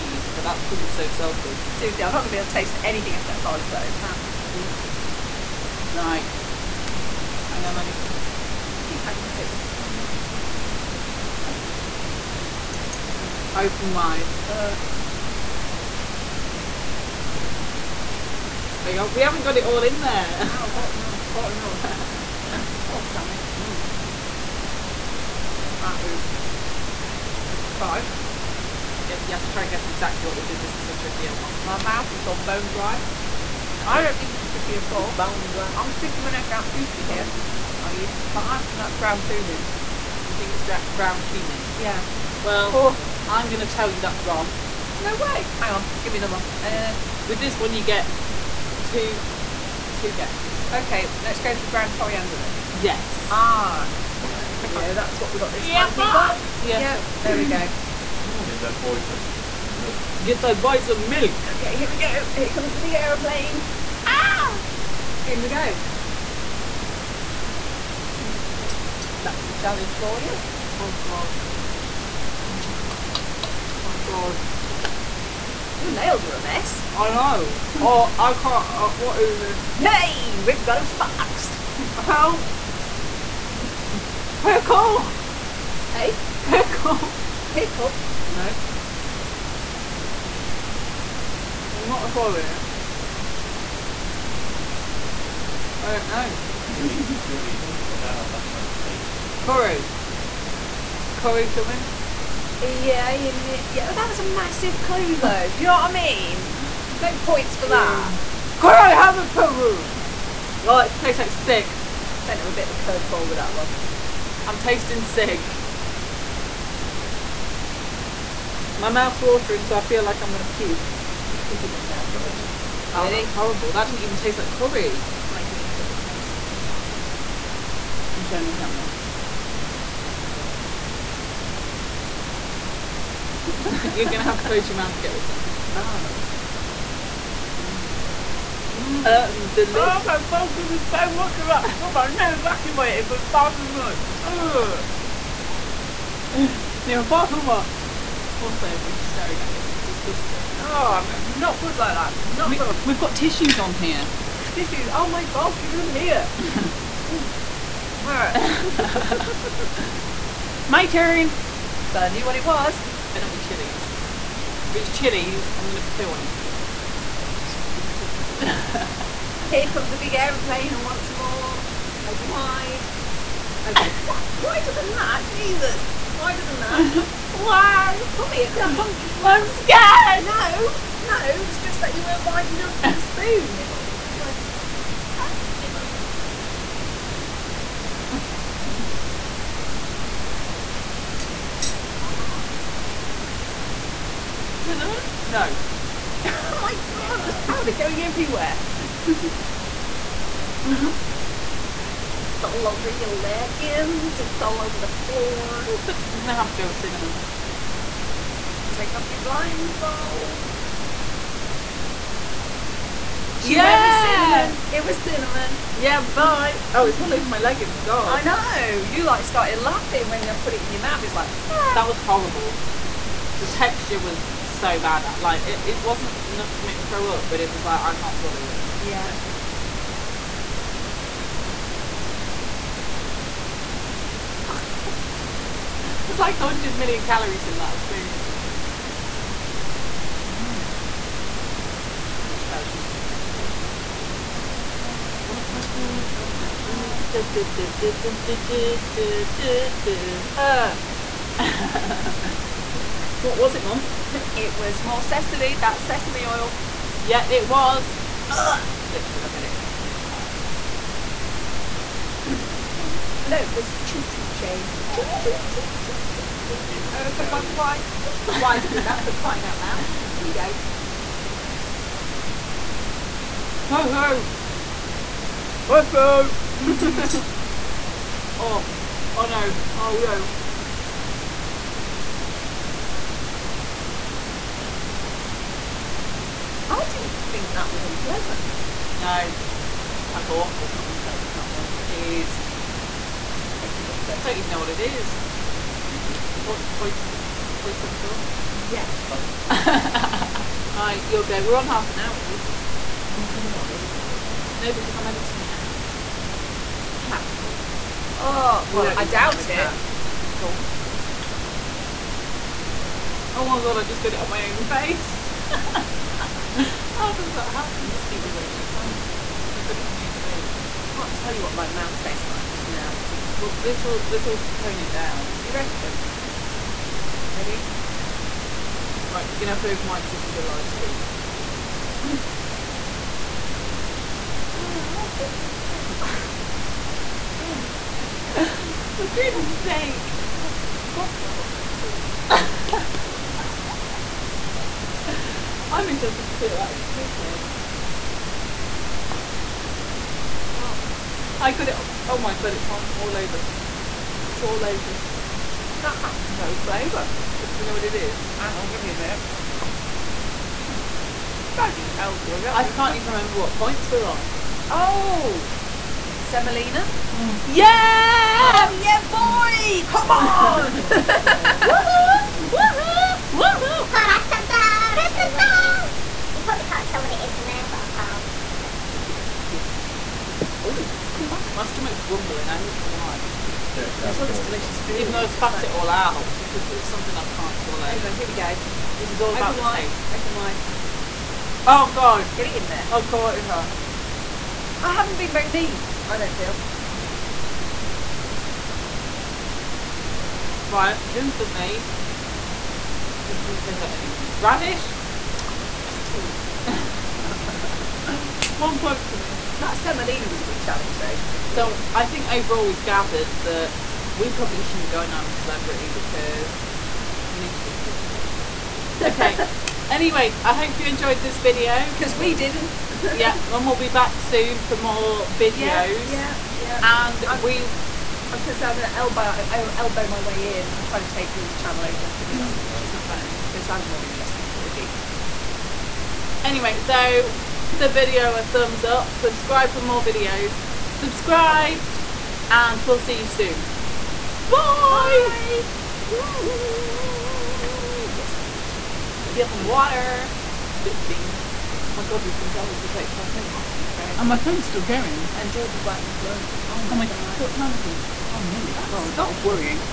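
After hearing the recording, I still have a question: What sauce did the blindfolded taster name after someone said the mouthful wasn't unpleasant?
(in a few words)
Hoisin sauce.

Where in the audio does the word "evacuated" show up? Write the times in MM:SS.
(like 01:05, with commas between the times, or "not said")
02:22.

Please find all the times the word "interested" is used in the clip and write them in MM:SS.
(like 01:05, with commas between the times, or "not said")
05:45, 07:14.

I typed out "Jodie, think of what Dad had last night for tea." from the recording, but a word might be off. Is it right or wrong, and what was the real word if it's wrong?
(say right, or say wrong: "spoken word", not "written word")
right.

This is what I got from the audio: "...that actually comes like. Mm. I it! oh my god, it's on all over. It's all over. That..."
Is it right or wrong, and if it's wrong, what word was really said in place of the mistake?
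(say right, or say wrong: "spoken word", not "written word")
wrong: "tastes", not "comes".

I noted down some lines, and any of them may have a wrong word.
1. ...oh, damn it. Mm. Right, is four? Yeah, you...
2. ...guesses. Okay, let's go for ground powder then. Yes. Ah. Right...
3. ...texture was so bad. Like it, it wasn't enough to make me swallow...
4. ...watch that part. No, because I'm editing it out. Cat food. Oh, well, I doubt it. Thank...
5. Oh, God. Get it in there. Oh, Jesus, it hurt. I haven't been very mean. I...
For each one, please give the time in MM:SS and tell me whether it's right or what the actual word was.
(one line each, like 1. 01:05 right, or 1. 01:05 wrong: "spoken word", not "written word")
1. 00:22 wrong: "five", not "four"
2. 00:50 wrong: "coriander", not "powder"
3. 03:43 wrong: "throw", not "swallow"
4. 05:04 right
5. 06:31 wrong: "God", not "Jesus".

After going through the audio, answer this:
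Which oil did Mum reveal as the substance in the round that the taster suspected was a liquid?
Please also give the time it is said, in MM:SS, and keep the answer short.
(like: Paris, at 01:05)
sesame oil, at 04:15.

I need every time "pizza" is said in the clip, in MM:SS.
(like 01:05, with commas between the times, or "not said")
03:06, 03:21.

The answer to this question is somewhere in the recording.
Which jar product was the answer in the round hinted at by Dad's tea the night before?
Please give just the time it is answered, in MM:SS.
02:05.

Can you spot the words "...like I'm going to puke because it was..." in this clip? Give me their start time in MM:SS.
02:00.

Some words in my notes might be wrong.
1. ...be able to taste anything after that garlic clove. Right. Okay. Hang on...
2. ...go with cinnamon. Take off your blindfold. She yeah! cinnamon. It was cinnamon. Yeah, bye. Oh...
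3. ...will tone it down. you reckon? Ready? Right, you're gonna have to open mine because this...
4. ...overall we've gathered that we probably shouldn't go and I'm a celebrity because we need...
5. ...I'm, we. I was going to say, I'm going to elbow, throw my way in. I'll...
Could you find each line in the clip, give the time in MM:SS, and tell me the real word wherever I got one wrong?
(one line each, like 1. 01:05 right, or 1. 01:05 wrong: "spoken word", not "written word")
1. 00:02 right
2. 03:26 right
3. 05:24 right
4. 06:52 right
5. 07:07 wrong: "elbow", not "throw".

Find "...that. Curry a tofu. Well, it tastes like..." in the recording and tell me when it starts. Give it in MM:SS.
01:47.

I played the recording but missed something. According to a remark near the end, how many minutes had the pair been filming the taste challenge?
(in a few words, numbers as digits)
35.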